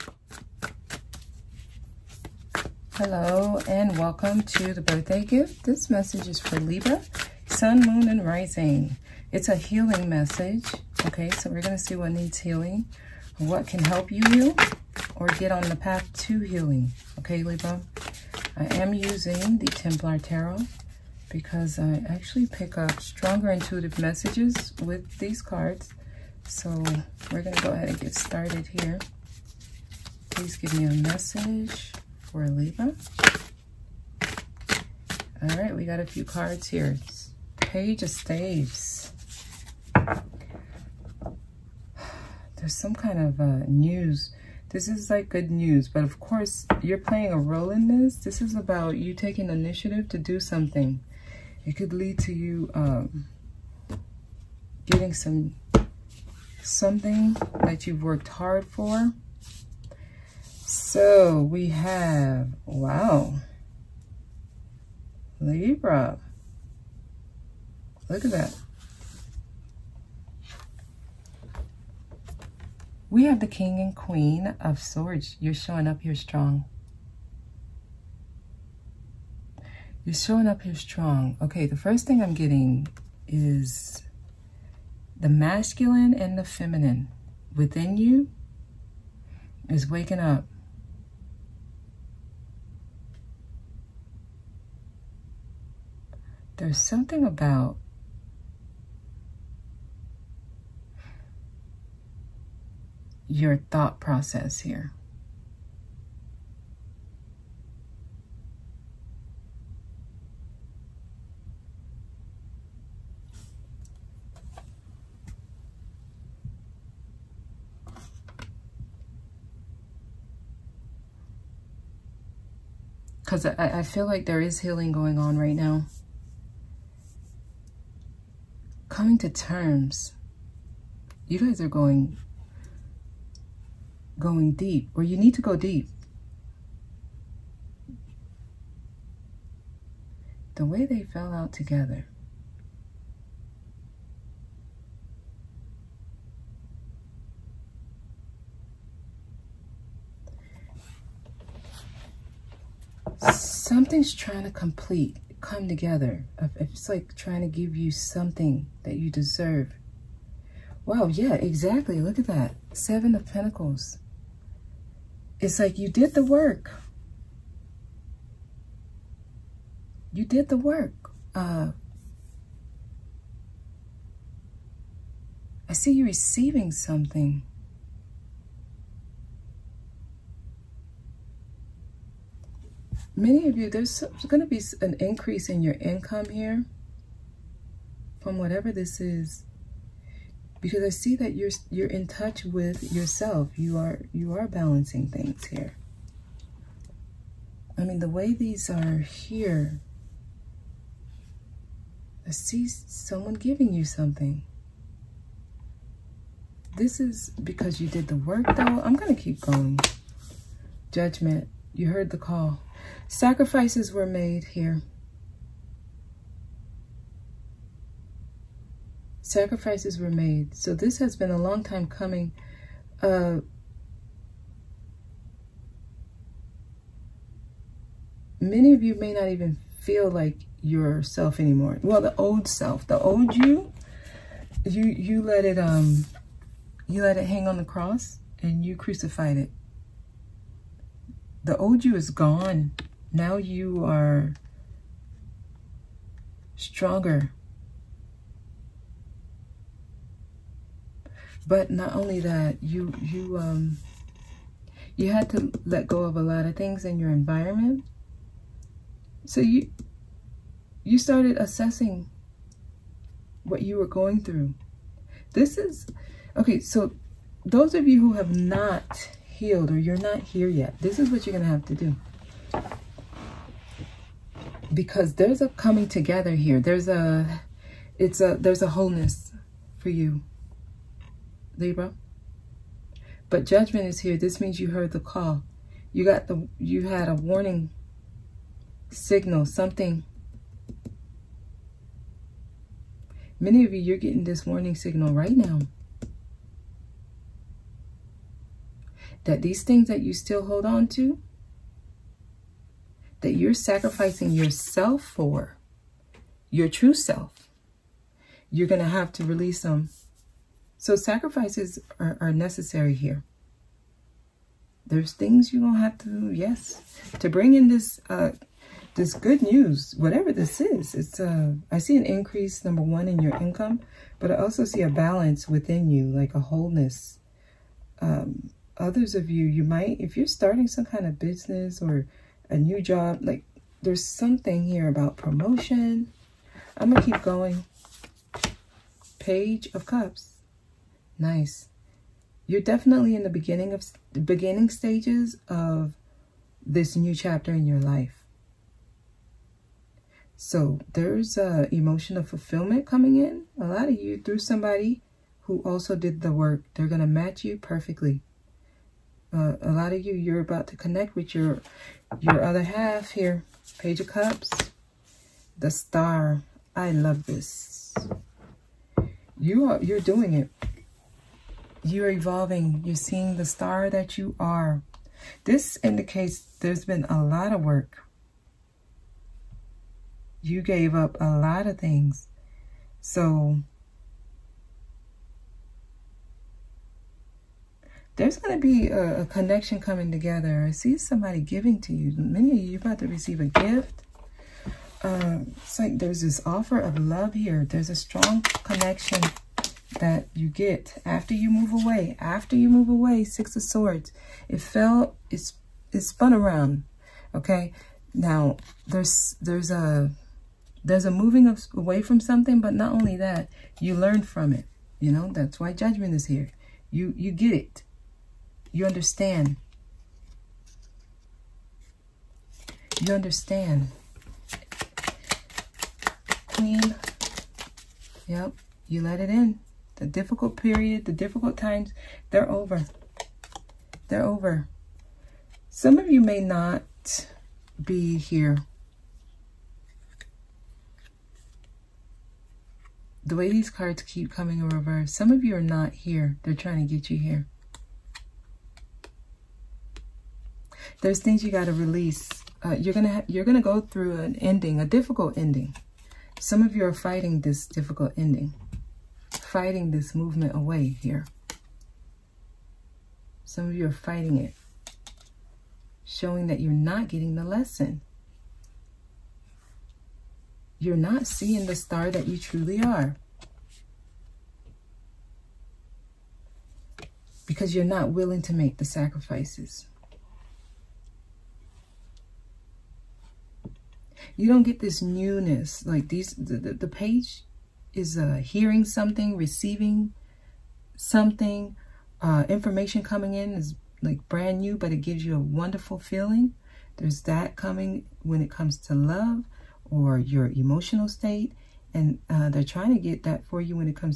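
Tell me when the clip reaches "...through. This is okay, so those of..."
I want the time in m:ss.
4:24.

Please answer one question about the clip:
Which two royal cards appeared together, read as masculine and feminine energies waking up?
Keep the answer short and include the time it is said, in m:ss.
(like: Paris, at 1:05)
King and Queen of Swords, at 1:13.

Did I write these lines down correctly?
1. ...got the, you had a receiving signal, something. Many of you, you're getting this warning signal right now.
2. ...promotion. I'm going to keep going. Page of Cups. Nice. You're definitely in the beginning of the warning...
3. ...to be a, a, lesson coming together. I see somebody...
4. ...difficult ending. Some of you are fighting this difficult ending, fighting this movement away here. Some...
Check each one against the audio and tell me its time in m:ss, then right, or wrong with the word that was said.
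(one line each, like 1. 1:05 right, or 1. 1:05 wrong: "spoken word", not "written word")
1. 4:46 wrong: "warning", not "receiving"
2. 5:35 wrong: "beginning", not "warning"
3. 6:28 wrong: "connection", not "lesson"
4. 7:34 right.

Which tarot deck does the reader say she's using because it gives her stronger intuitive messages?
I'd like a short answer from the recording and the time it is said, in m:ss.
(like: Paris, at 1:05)
Templar Tarot, at 0:19.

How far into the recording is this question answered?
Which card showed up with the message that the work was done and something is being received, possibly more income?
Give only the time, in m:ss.
2:42.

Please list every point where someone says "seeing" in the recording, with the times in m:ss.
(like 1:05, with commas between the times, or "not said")
6:12, 7:51.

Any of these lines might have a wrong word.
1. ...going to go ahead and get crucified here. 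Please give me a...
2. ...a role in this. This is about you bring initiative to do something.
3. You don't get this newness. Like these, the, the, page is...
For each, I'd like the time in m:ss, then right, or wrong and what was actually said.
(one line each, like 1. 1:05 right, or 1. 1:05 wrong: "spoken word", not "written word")
1. 0:27 wrong: "started", not "crucified"
2. 0:47 wrong: "taking", not "bring"
3. 8:04 right.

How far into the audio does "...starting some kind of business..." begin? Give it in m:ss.
5:30.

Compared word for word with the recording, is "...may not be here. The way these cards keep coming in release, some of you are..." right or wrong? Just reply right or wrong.
wrong.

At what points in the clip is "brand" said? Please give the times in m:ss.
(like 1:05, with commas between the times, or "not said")
8:14.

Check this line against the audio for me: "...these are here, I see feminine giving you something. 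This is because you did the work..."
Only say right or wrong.
wrong.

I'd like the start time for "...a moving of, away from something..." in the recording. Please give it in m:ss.
6:51.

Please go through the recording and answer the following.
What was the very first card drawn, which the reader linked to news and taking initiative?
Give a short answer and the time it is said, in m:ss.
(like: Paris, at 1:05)
Page of Staves, at 0:37.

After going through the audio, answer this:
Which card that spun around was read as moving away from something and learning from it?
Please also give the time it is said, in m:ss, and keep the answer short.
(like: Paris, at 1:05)
Six of Swords, at 6:43.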